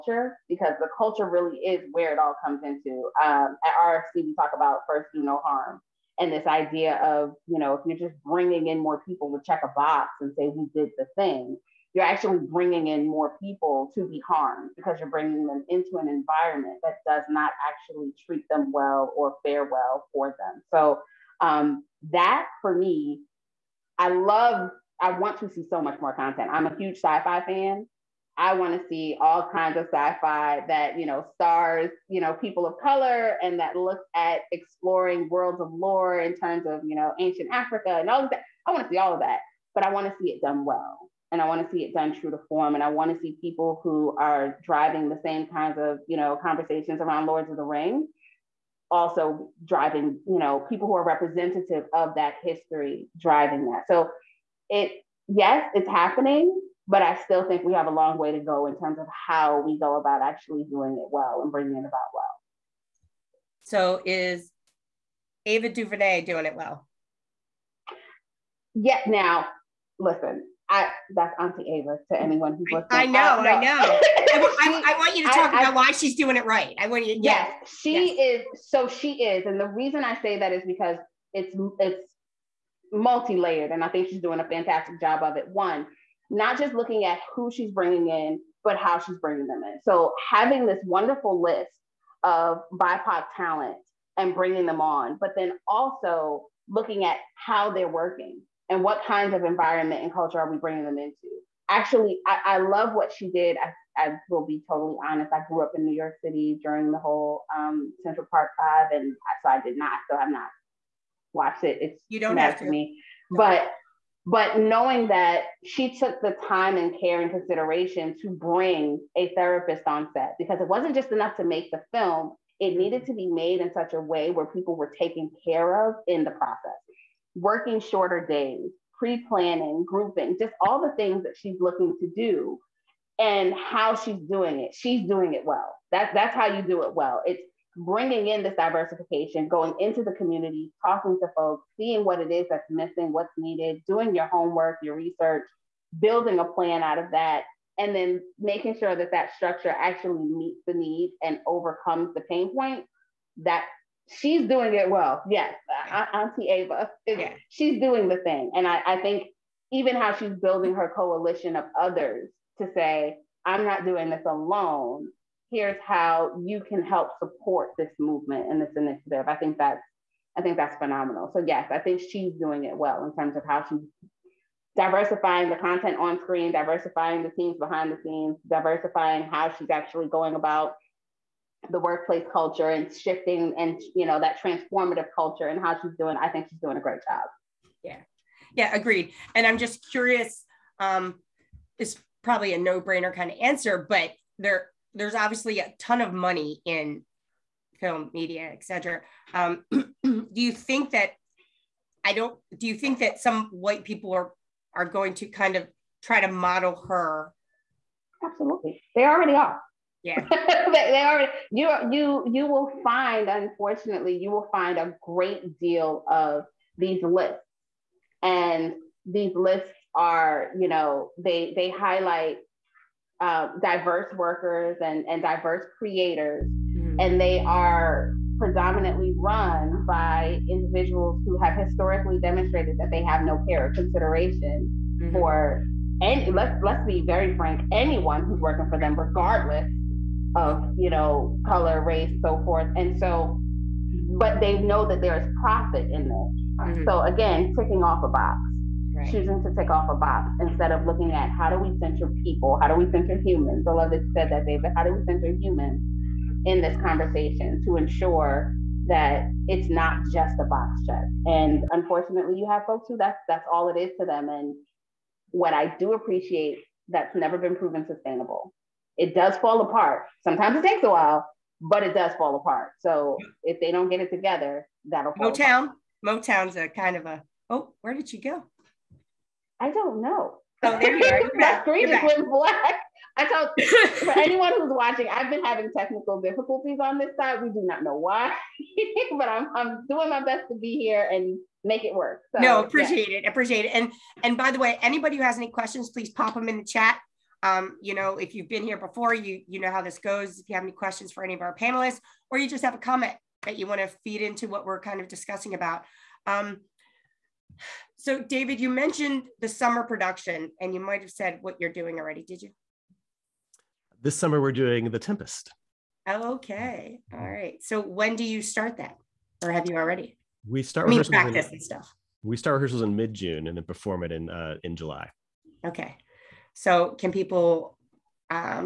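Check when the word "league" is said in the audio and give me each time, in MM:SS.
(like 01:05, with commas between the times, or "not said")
not said.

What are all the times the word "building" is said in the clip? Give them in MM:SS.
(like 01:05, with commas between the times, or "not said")
02:25, 02:40.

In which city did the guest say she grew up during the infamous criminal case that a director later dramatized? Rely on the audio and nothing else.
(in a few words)
New York City.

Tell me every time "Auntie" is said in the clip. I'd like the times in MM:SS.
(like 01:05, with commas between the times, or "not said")
01:11, 02:36.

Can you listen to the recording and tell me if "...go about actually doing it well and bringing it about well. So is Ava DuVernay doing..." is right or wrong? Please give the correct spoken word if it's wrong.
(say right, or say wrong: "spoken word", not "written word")
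right.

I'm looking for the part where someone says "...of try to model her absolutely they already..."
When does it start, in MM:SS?
03:25.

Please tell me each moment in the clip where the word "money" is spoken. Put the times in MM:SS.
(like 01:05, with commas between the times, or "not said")
03:16.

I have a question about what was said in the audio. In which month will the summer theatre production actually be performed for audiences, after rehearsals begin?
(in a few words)
July.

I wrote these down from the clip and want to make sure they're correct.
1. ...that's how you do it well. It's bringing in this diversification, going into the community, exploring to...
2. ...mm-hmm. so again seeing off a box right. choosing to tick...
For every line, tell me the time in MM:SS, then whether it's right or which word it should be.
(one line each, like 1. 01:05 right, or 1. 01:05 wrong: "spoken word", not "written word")
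1. 02:16 wrong: "talking", not "exploring"
2. 04:06 wrong: "ticking", not "seeing".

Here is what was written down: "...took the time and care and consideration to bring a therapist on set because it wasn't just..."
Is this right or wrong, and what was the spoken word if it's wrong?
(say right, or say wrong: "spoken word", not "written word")
right.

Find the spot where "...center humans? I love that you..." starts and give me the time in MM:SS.
04:12.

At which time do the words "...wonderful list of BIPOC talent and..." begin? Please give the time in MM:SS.
01:30.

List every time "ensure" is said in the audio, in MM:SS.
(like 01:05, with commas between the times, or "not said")
04:17.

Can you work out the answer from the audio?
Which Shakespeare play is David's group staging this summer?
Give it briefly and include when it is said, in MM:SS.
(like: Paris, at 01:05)
The Tempest, at 05:14.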